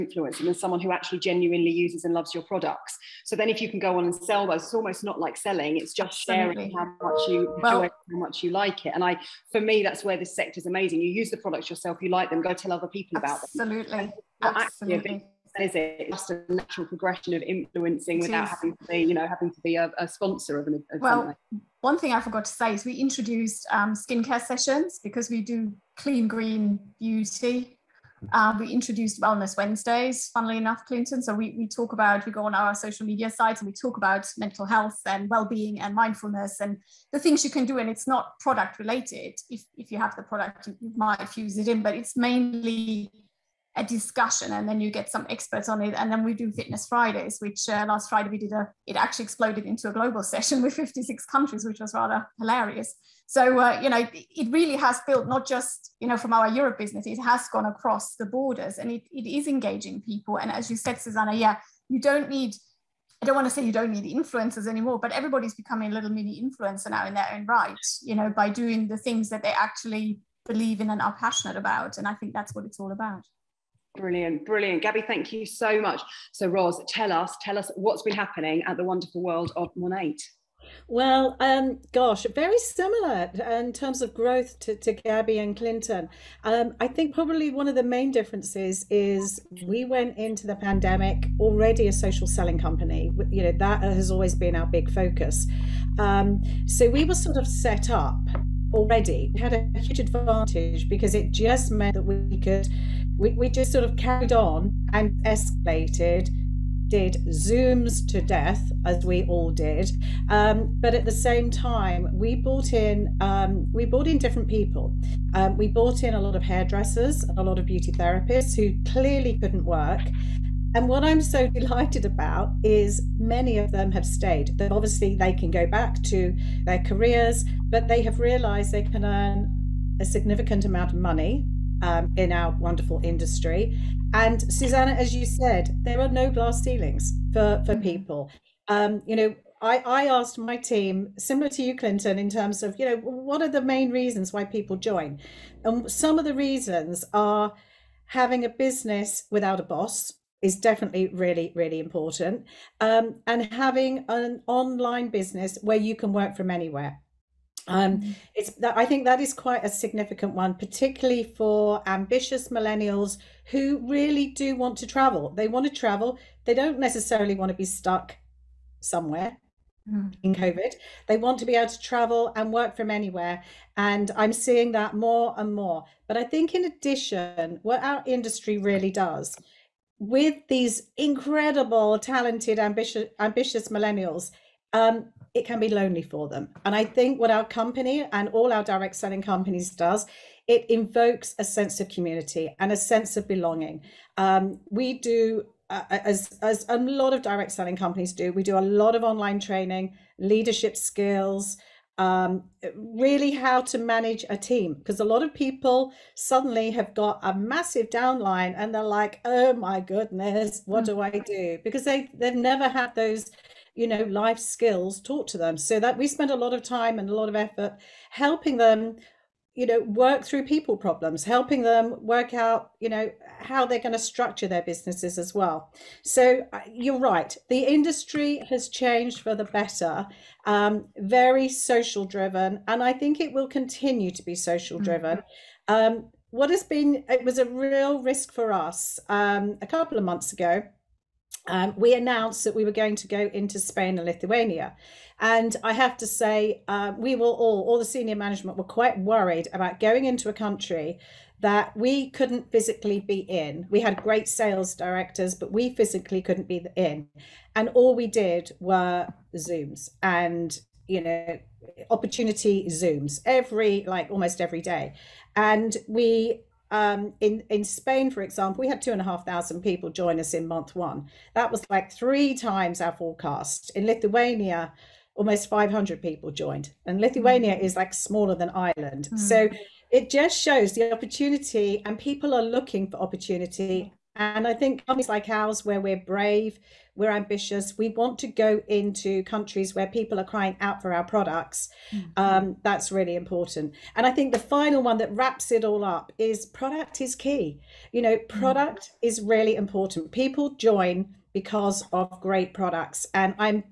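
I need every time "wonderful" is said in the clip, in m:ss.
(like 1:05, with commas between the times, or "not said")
1:18, 2:12.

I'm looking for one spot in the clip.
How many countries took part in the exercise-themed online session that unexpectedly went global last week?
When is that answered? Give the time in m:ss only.
0:50.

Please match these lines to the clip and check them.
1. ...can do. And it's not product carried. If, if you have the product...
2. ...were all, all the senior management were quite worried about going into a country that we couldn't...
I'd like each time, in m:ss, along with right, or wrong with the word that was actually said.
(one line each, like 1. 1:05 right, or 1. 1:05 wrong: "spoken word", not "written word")
1. 0:37 wrong: "related", not "carried"
2. 4:07 right.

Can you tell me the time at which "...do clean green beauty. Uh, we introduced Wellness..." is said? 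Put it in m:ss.
0:25.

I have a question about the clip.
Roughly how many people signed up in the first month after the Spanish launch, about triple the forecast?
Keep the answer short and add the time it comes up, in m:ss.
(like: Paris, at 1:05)
2,500, at 4:28.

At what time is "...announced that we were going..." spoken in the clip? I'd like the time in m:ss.
4:01.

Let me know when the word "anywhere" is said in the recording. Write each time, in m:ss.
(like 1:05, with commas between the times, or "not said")
2:36, 2:52.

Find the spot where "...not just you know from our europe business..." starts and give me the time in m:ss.
0:55.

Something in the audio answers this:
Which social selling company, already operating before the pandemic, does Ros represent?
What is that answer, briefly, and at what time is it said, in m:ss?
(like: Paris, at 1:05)
MONAT, at 1:19.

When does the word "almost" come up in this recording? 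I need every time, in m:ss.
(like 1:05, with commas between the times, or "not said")
0:04, 4:24, 4:35.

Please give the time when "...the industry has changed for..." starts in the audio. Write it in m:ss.
3:47.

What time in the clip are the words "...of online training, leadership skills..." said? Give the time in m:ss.
3:18.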